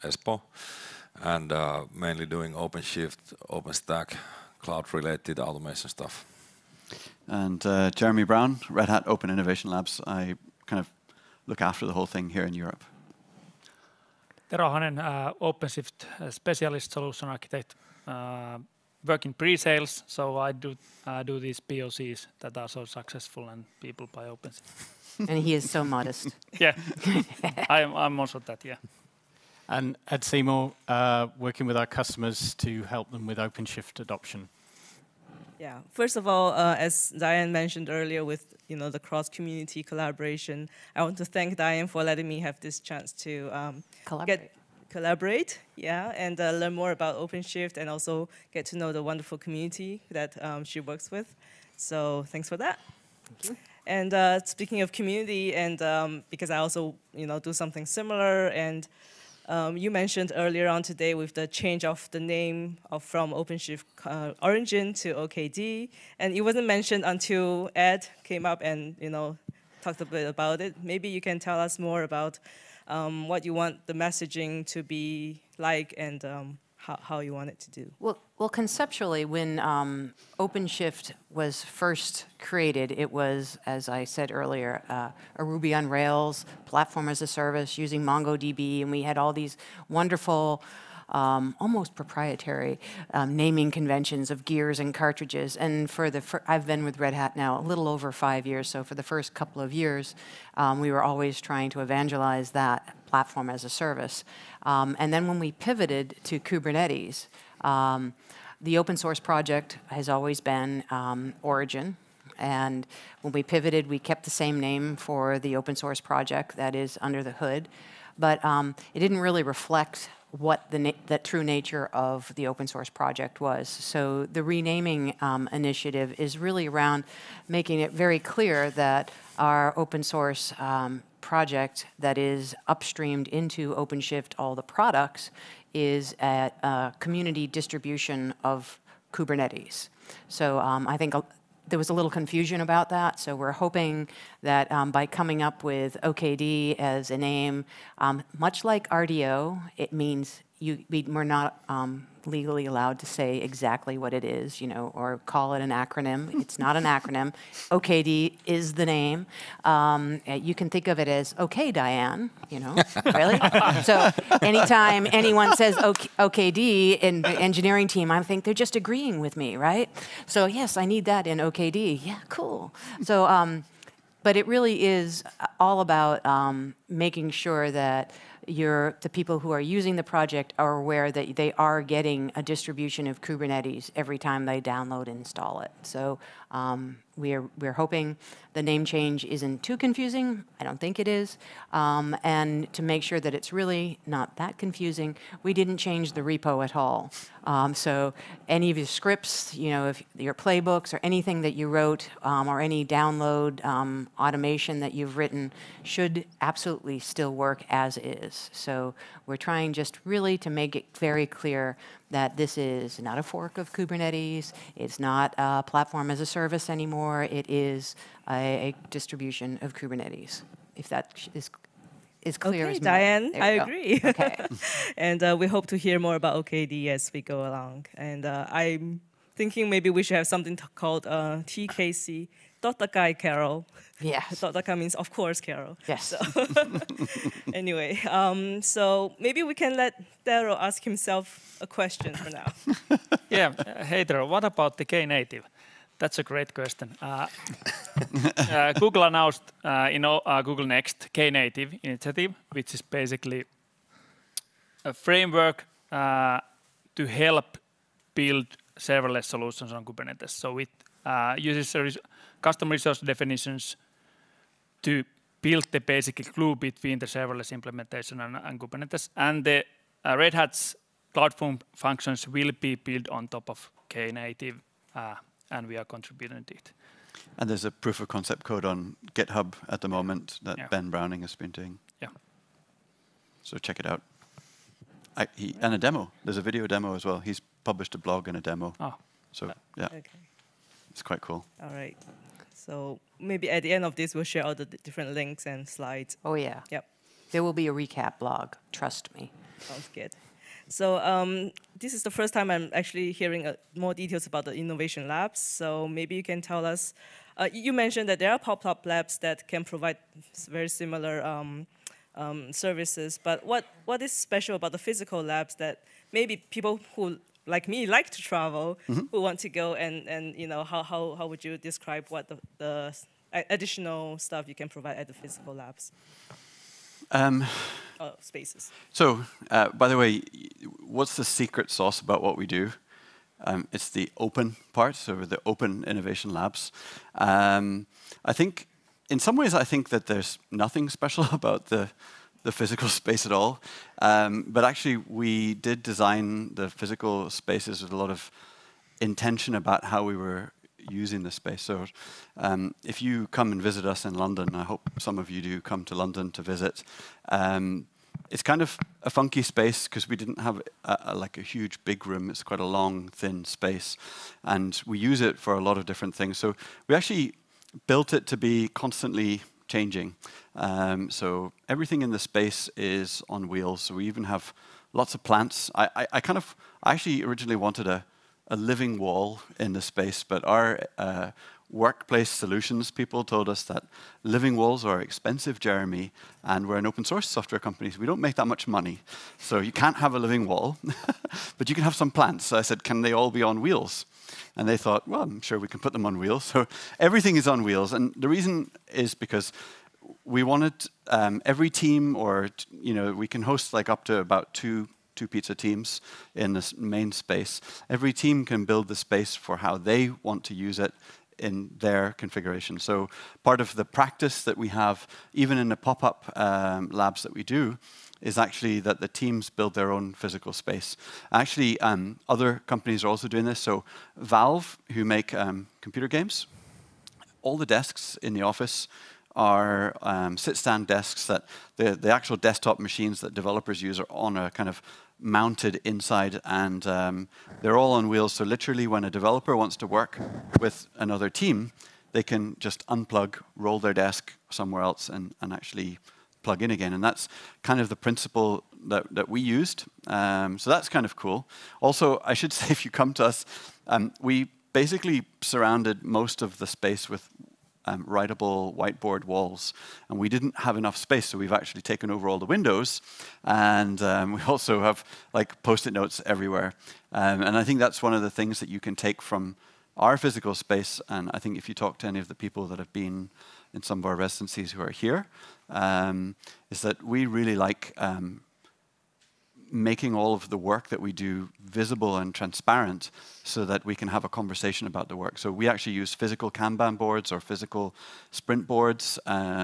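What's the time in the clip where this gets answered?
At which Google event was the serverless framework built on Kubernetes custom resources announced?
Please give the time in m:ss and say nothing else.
4:10.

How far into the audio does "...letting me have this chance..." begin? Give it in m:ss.
0:42.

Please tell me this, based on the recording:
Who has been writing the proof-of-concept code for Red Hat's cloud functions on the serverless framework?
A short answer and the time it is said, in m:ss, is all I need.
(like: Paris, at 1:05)
Ben Browning, at 4:40.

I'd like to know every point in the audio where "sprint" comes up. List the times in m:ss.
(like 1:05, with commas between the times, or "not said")
8:08.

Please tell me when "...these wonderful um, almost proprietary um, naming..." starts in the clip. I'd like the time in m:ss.
1:29.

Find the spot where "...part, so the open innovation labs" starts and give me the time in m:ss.
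5:34.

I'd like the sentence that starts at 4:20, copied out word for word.
So it uh, uses res custom resource definitions to build the basic glue between the serverless implementation and, and Kubernetes.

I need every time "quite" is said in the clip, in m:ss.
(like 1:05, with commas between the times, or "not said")
4:51, 6:02.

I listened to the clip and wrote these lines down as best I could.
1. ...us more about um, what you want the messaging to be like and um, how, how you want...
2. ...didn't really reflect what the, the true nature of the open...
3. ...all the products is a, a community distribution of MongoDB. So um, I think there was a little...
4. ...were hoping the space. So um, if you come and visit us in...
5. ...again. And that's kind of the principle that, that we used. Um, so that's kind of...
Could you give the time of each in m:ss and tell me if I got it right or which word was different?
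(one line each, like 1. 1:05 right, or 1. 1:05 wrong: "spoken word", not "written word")
1. 1:11 right
2. 1:58 right
3. 2:14 wrong: "Kubernetes", not "MongoDB"
4. 5:50 wrong: "using", not "hoping"
5. 7:26 right.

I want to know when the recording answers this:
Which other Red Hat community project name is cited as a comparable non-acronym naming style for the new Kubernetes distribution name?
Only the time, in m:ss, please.
2:28.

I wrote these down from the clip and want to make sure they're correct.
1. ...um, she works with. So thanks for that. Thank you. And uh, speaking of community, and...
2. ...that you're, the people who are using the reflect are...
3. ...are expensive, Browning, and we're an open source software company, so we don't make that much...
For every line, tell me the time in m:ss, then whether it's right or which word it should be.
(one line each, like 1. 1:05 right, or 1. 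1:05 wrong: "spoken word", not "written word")
1. 0:50 right
2. 2:57 wrong: "project", not "reflect"
3. 6:24 wrong: "Jeremy", not "Browning".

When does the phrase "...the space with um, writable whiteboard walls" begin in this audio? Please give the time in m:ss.
7:36.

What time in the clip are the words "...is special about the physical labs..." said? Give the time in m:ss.
5:14.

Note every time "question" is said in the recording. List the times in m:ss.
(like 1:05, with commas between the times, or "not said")
4:01, 4:06.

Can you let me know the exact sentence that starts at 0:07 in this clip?
And uh, Jeremy Brown, Red Hat Open Innovation Labs.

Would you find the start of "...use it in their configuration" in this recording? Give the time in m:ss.
6:50.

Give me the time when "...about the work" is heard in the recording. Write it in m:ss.
8:04.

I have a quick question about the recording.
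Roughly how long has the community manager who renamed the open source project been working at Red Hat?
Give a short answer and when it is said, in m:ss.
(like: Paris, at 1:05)
a little over five years, at 1:37.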